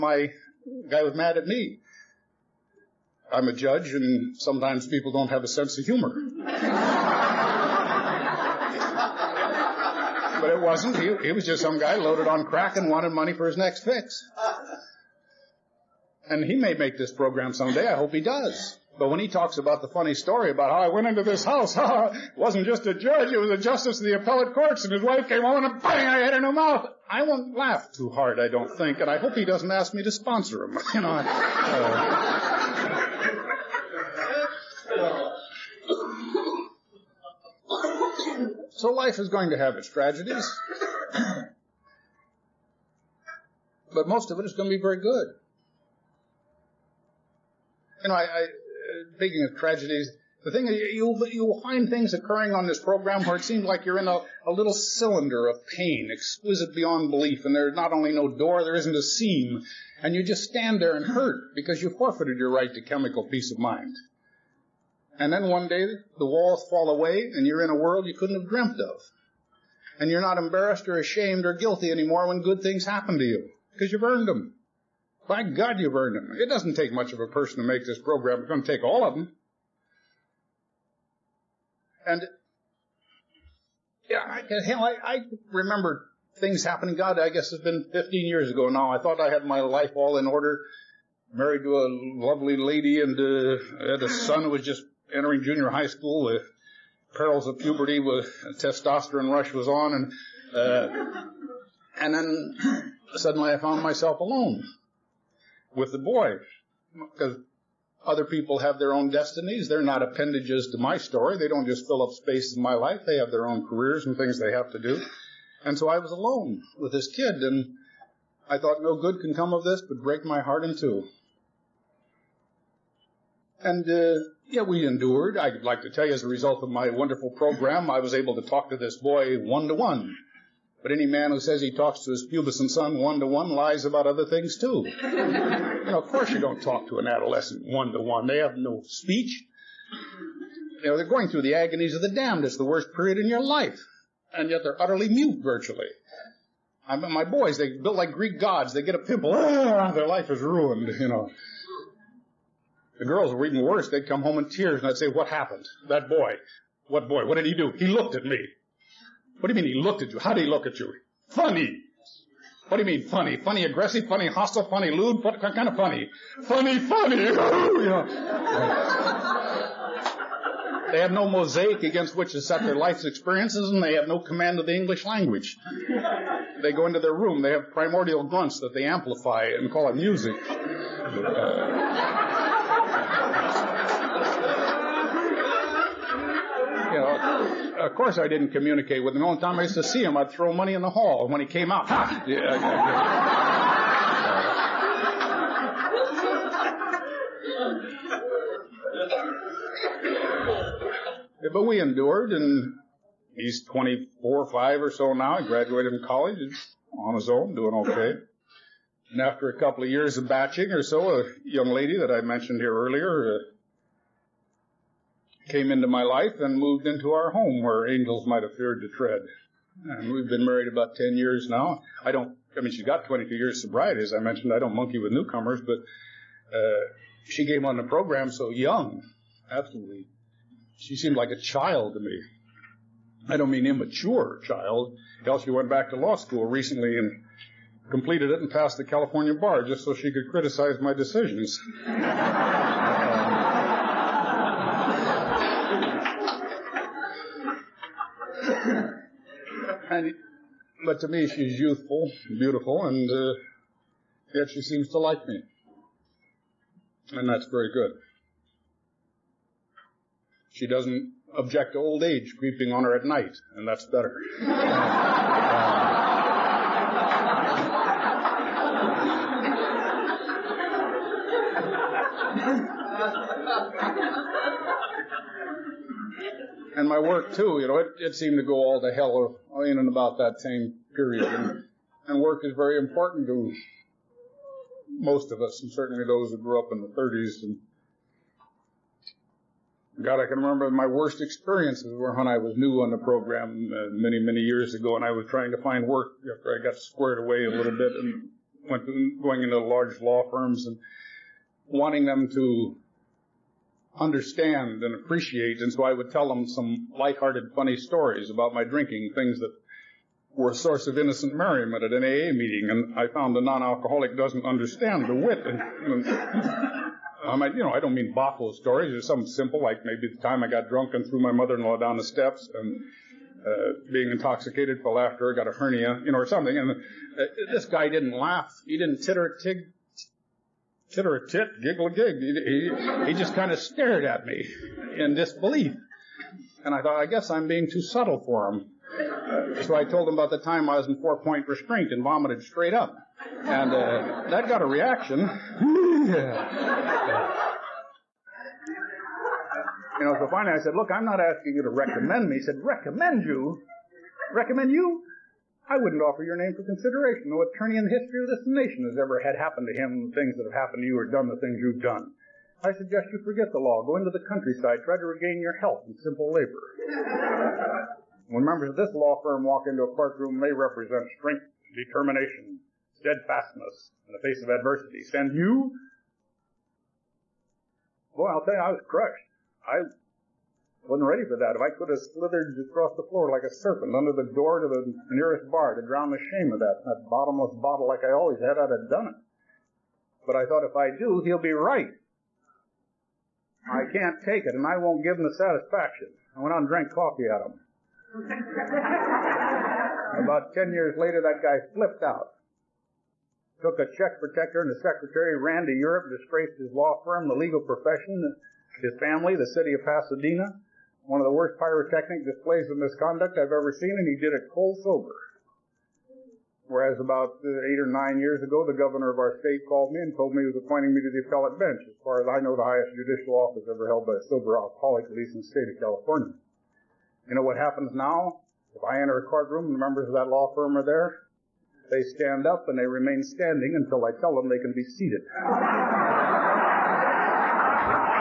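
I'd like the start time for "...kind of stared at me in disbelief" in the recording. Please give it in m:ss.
5:33.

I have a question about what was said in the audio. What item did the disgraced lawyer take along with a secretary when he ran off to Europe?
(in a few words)
check protector.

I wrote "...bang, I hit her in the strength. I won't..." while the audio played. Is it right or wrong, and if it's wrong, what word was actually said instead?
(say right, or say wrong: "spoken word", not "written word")
wrong: "mouth", not "strength".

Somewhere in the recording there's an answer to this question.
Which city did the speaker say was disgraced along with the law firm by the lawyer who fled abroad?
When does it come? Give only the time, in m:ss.
6:49.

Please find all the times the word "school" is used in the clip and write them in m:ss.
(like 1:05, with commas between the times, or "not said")
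1:35, 3:56.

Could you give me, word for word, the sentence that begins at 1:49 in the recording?
They're not appendages to my story.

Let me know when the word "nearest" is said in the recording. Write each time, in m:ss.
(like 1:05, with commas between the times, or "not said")
6:25.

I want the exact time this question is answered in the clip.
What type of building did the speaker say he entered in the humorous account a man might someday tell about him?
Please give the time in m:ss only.
0:21.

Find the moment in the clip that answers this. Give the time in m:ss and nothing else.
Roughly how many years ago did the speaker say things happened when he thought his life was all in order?
1:27.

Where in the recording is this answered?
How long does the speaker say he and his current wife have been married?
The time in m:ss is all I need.
3:40.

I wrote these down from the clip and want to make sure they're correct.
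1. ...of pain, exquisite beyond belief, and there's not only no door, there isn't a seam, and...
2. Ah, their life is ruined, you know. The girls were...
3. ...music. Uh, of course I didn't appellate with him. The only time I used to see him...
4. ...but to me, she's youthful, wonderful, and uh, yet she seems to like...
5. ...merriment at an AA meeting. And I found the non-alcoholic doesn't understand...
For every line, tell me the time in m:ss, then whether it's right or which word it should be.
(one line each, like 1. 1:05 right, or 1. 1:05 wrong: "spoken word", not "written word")
1. 0:55 right
2. 2:29 right
3. 2:59 wrong: "communicate", not "appellate"
4. 4:10 wrong: "beautiful", not "wonderful"
5. 5:11 right.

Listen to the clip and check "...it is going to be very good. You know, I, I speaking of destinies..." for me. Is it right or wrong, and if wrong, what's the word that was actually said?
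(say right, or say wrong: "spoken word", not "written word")
wrong: "tragedies", not "destinies".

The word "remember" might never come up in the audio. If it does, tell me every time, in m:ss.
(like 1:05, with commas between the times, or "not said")
1:25, 4:50.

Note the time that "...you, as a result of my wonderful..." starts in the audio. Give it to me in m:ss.
2:06.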